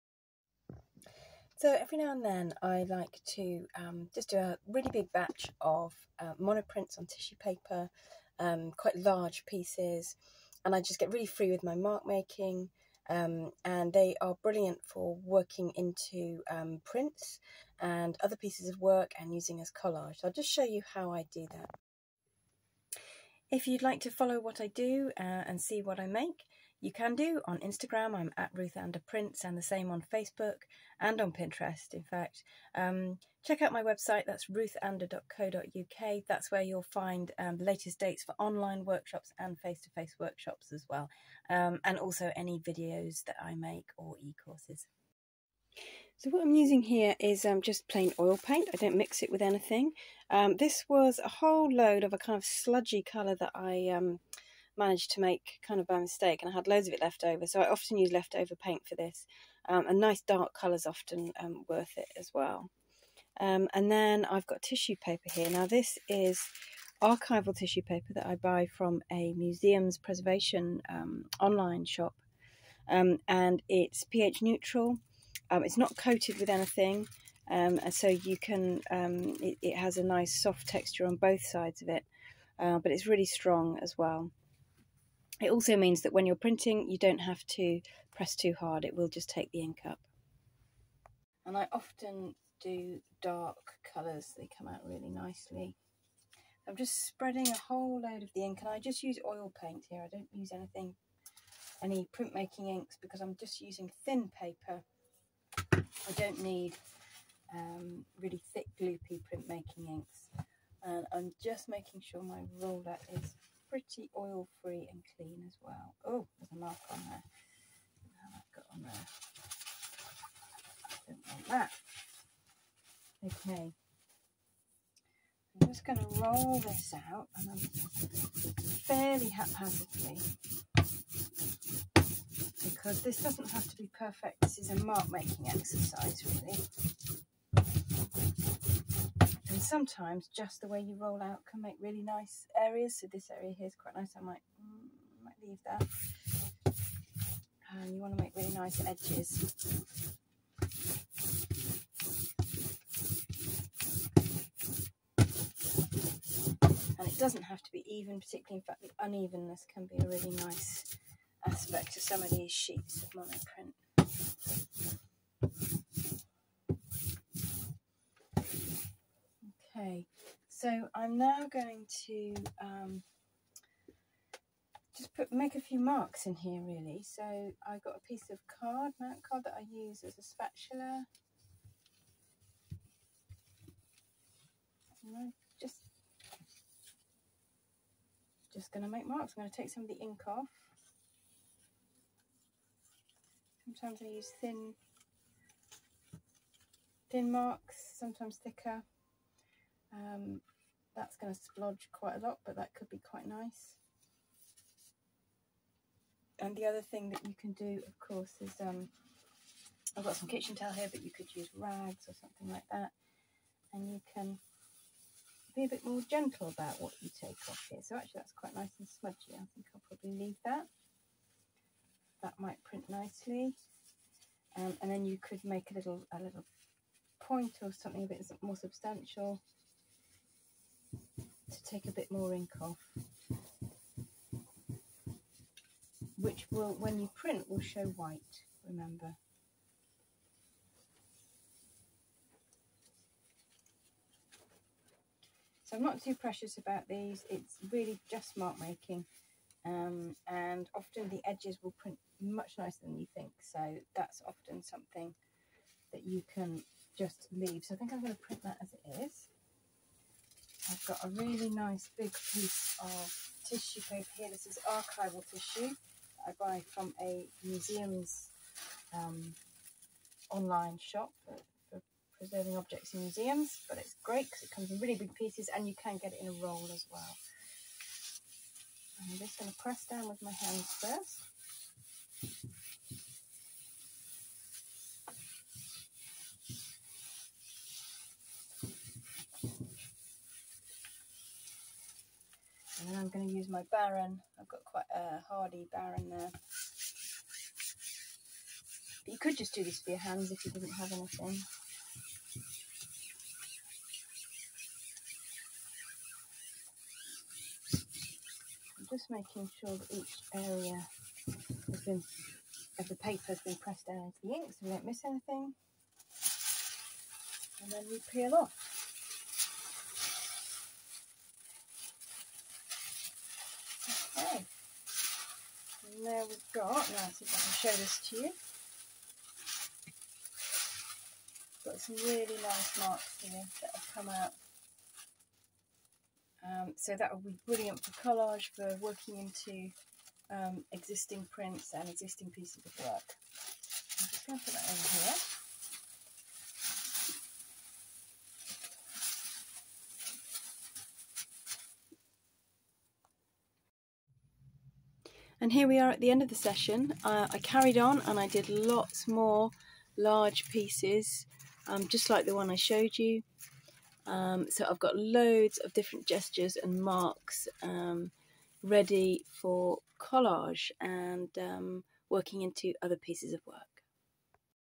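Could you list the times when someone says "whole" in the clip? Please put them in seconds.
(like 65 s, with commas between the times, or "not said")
51 s, 97 s.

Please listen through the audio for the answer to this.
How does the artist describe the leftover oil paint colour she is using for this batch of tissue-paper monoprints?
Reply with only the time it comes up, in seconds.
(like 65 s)
52 s.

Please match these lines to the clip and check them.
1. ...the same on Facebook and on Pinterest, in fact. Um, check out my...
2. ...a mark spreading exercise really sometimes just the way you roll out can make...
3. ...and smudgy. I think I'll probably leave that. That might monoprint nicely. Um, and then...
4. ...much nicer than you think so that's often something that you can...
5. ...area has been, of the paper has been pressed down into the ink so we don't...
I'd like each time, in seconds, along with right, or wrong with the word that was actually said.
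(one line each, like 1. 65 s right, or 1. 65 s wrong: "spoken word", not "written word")
1. 29 s right
2. 134 s wrong: "making", not "spreading"
3. 218 s wrong: "print", not "monoprint"
4. 252 s right
5. 310 s right.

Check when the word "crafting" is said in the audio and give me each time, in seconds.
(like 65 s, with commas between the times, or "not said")
not said.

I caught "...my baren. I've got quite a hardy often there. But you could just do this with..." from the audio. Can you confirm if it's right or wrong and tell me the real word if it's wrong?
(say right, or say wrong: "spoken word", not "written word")
wrong: "baren", not "often".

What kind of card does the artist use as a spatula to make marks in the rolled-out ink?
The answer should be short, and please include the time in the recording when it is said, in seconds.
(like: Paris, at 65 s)
mount card, at 178 s.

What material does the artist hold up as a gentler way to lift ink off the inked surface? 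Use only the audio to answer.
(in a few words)
kitchen towel.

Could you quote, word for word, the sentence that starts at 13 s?
Um, and they are brilliant for working into um, prints and other pieces of work and using as collage.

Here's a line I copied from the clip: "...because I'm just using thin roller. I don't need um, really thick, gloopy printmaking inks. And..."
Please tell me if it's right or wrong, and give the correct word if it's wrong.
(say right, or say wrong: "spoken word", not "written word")
wrong: "paper", not "roller".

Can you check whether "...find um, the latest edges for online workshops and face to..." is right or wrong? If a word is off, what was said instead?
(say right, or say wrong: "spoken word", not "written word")
wrong: "dates", not "edges".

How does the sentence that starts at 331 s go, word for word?
Got some really nice marks here that have come out.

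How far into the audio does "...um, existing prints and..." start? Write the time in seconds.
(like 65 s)
340 s.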